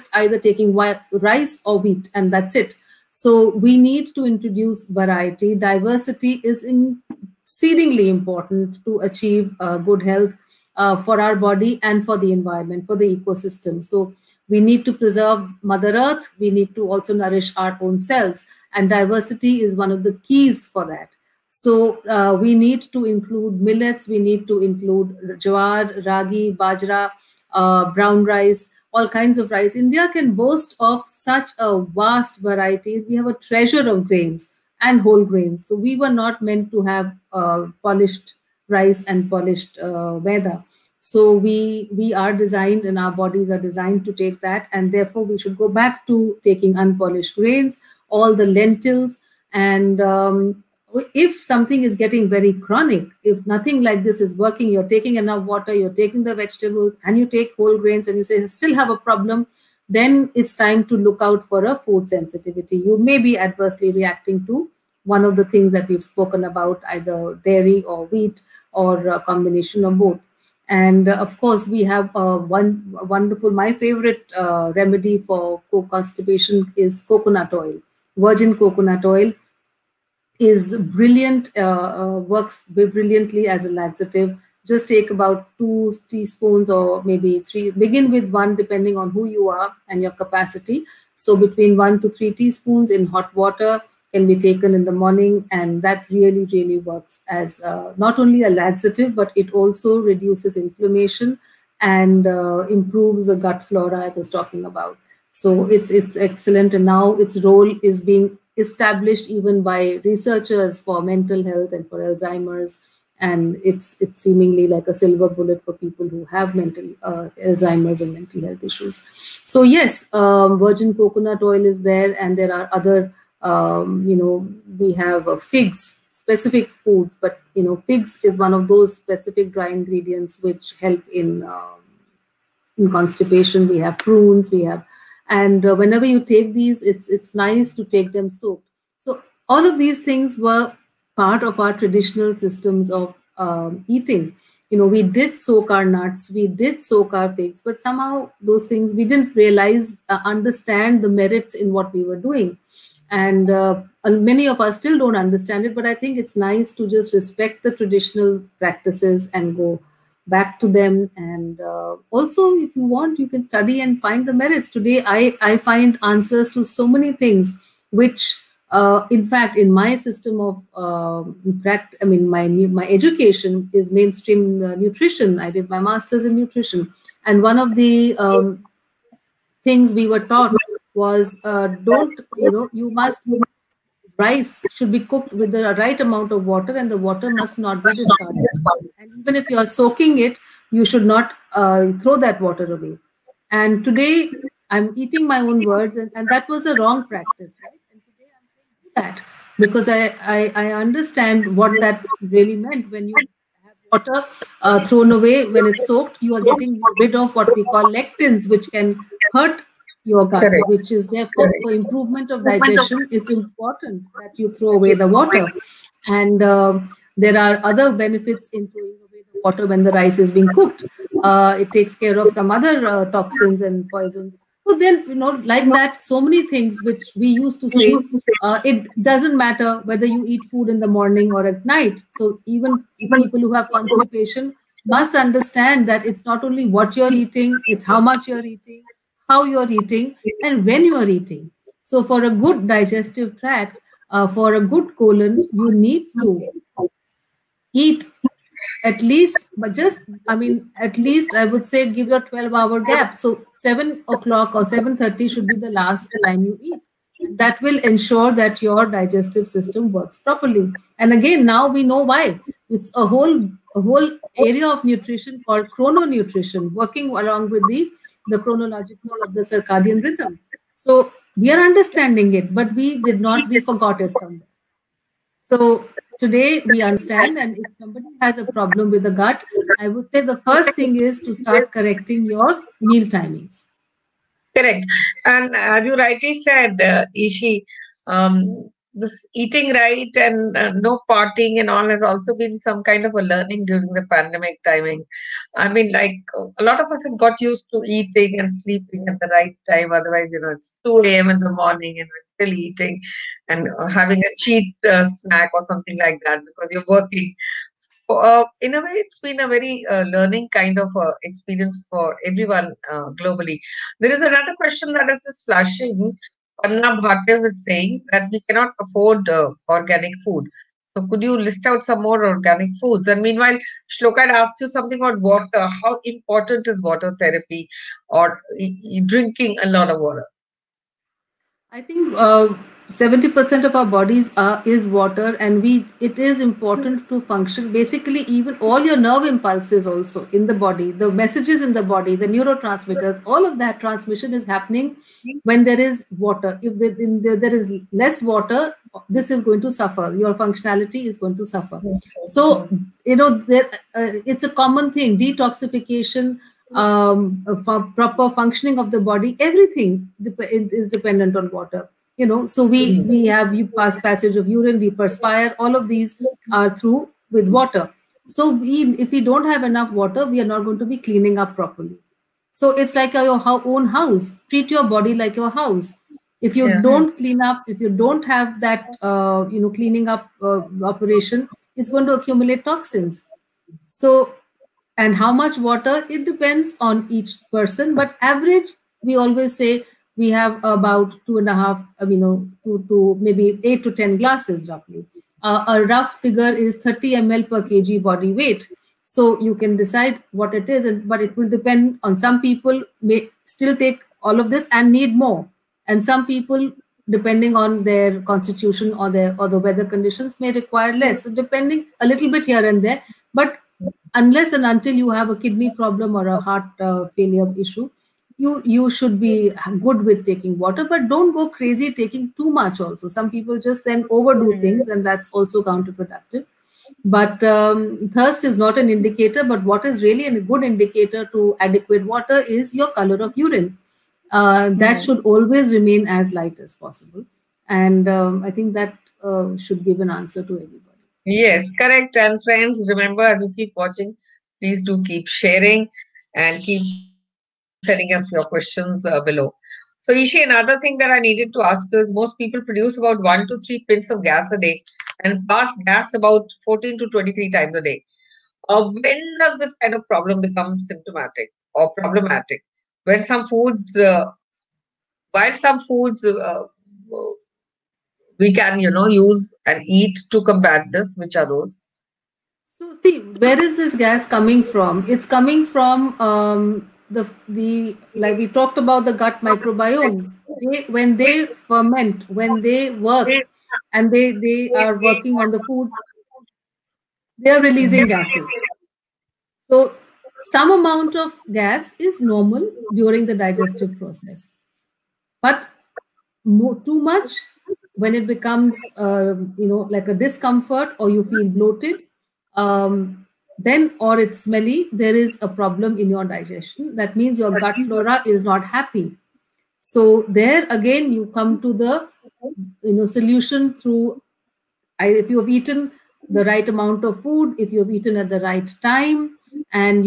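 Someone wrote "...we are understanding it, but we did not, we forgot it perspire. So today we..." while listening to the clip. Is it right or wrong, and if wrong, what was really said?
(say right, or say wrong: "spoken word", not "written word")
wrong: "somewhere", not "perspire".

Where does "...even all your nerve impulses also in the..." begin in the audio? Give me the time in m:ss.
5:38.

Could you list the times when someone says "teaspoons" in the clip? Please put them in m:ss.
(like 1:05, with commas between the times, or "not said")
1:26, 1:32.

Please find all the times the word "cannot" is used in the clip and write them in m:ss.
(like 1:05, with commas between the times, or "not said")
5:18.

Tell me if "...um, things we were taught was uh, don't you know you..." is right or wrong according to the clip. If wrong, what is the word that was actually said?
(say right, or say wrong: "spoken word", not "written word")
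right.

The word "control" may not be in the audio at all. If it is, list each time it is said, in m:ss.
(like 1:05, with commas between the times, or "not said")
not said.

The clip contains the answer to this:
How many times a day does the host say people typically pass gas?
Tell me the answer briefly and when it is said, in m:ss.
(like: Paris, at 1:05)
14 to 23, at 7:36.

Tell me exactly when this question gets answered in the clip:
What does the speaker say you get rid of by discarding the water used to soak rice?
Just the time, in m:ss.
3:27.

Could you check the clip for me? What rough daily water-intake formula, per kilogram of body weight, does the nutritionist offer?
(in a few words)
30 ml per kg.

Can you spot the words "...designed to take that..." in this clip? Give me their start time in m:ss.
0:43.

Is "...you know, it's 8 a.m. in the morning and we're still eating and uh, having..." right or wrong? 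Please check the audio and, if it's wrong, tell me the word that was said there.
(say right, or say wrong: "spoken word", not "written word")
wrong: "2", not "8".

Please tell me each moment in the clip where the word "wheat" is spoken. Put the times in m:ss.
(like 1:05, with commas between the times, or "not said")
0:01, 1:08.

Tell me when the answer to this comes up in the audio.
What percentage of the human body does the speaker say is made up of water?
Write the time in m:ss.
5:32.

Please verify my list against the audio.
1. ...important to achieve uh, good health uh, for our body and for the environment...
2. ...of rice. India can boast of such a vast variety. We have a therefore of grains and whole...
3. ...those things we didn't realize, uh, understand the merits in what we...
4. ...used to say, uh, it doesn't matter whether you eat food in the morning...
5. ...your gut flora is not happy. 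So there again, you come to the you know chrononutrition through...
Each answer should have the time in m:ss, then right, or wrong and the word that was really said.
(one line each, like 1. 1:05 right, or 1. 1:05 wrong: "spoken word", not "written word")
1. 0:08 right
2. 0:29 wrong: "treasure", not "therefore"
3. 2:28 right
4. 3:47 right
5. 8:27 wrong: "solution", not "chrononutrition".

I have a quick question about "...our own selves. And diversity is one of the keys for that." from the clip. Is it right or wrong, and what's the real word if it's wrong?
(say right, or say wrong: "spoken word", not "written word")
right.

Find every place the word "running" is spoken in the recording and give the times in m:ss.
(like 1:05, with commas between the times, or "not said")
not said.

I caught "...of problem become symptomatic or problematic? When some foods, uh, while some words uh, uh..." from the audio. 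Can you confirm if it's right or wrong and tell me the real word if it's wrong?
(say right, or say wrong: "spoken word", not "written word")
wrong: "foods", not "words".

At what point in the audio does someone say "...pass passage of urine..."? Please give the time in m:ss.
6:03.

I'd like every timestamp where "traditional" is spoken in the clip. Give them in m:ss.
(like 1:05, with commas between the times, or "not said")
2:21, 2:37.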